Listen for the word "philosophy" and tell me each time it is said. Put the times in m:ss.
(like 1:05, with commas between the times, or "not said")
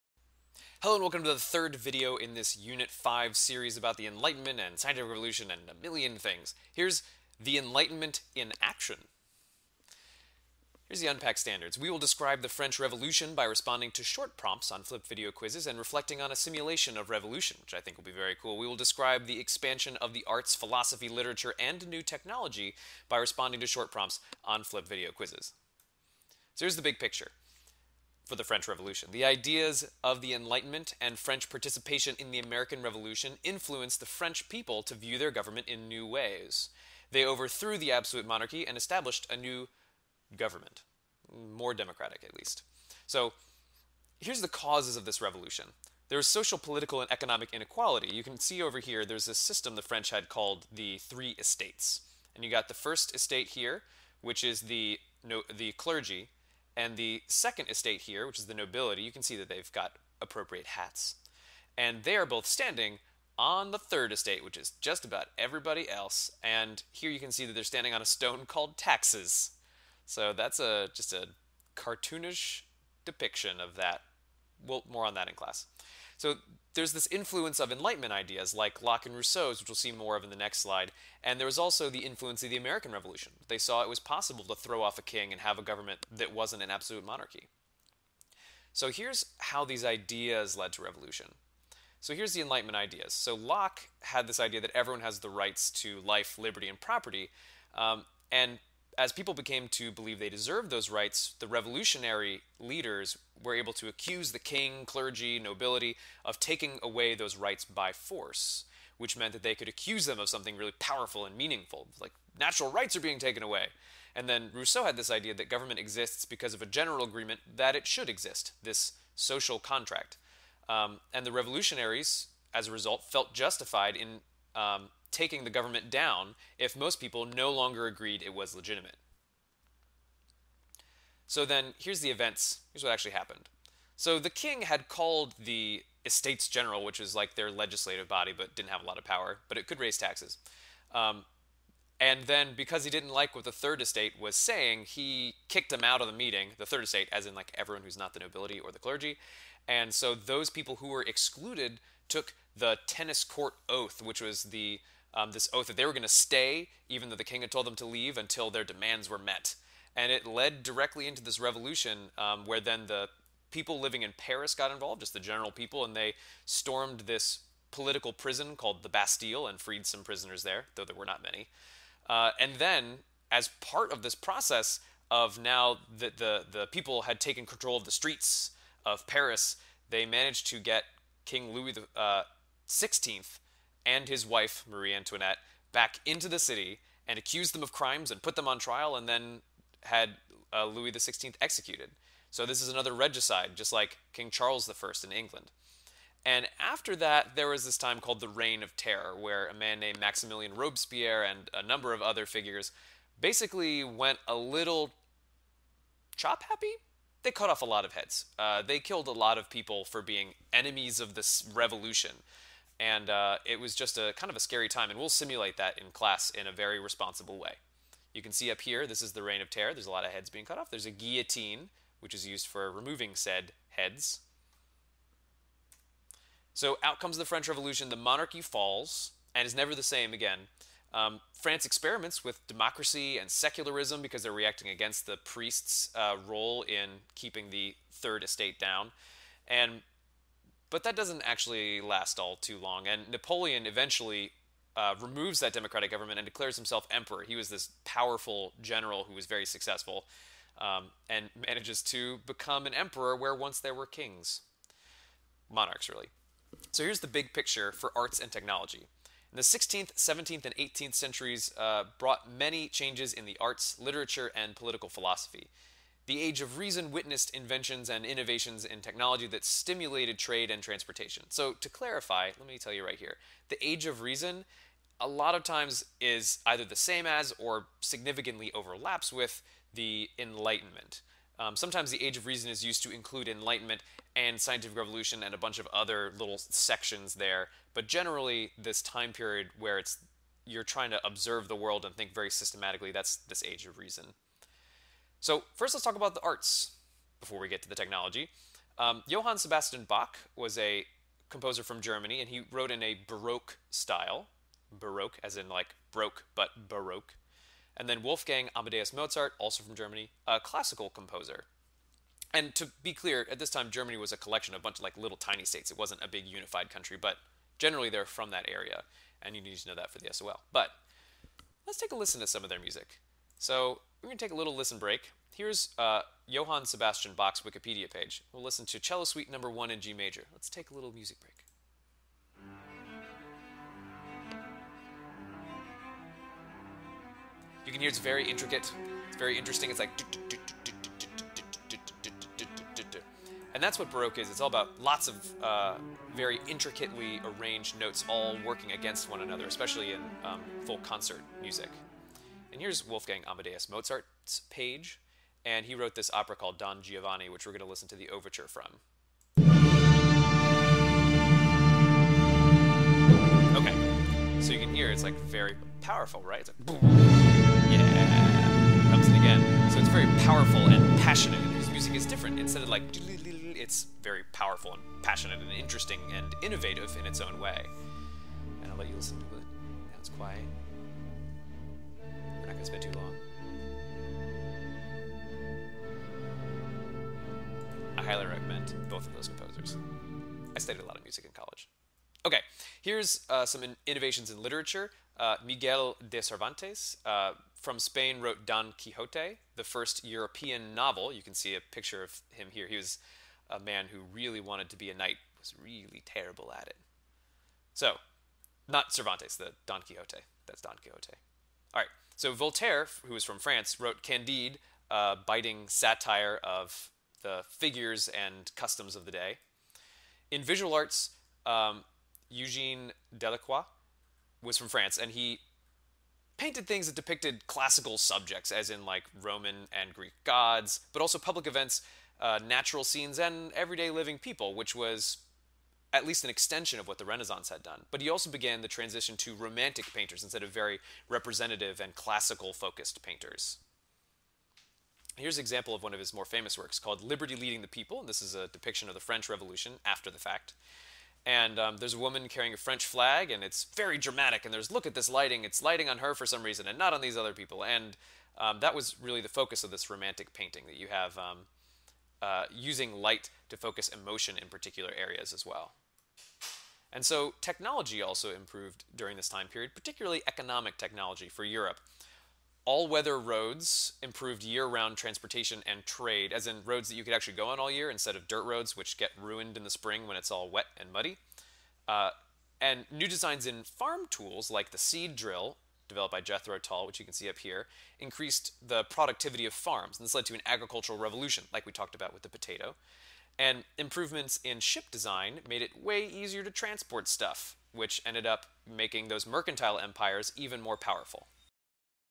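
0:20, 4:24.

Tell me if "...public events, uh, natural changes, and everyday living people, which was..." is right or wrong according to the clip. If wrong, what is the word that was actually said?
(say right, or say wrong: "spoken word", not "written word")
wrong: "scenes", not "changes".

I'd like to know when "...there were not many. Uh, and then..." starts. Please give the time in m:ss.
2:50.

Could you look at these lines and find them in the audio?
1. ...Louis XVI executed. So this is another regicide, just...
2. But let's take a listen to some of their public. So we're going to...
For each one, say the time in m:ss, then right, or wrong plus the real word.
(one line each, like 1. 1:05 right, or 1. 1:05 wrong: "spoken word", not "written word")
1. 3:10 right
2. 5:20 wrong: "music", not "public".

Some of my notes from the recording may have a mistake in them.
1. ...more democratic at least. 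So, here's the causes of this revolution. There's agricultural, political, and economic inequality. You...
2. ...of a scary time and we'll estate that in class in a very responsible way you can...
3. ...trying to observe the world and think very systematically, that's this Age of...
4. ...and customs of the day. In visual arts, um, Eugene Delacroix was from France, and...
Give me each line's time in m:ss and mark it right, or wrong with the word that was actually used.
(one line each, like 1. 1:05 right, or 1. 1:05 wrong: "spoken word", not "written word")
1. 0:41 wrong: "social", not "agricultural"
2. 3:34 wrong: "simulate", not "estate"
3. 4:50 right
4. 6:58 right.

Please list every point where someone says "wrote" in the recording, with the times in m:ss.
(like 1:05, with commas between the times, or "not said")
5:02, 5:55, 6:38, 6:53.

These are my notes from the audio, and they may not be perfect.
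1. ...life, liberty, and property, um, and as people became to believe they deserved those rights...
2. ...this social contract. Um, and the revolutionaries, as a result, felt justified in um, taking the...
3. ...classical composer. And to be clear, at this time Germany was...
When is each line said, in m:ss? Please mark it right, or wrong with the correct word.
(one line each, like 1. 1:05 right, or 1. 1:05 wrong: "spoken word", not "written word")
1. 1:35 right
2. 1:58 right
3. 5:10 right.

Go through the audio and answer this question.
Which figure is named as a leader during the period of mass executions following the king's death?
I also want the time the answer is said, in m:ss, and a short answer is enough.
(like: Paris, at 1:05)
Maximilian Robespierre, at 3:19.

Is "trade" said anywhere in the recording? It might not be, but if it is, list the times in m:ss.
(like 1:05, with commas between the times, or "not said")
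4:30, 7:55.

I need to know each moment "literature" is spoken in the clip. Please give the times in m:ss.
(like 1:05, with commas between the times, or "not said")
0:21, 4:23, 6:34.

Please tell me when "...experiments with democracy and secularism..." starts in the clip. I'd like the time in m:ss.
3:51.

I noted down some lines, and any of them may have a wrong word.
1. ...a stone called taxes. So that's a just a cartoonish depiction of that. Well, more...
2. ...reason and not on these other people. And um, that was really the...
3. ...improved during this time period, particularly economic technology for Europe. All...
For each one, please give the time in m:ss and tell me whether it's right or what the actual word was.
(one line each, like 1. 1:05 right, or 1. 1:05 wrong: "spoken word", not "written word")
1. 1:08 right
2. 7:36 right
3. 7:48 right.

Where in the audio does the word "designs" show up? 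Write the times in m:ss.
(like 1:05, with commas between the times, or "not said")
8:03, 8:14.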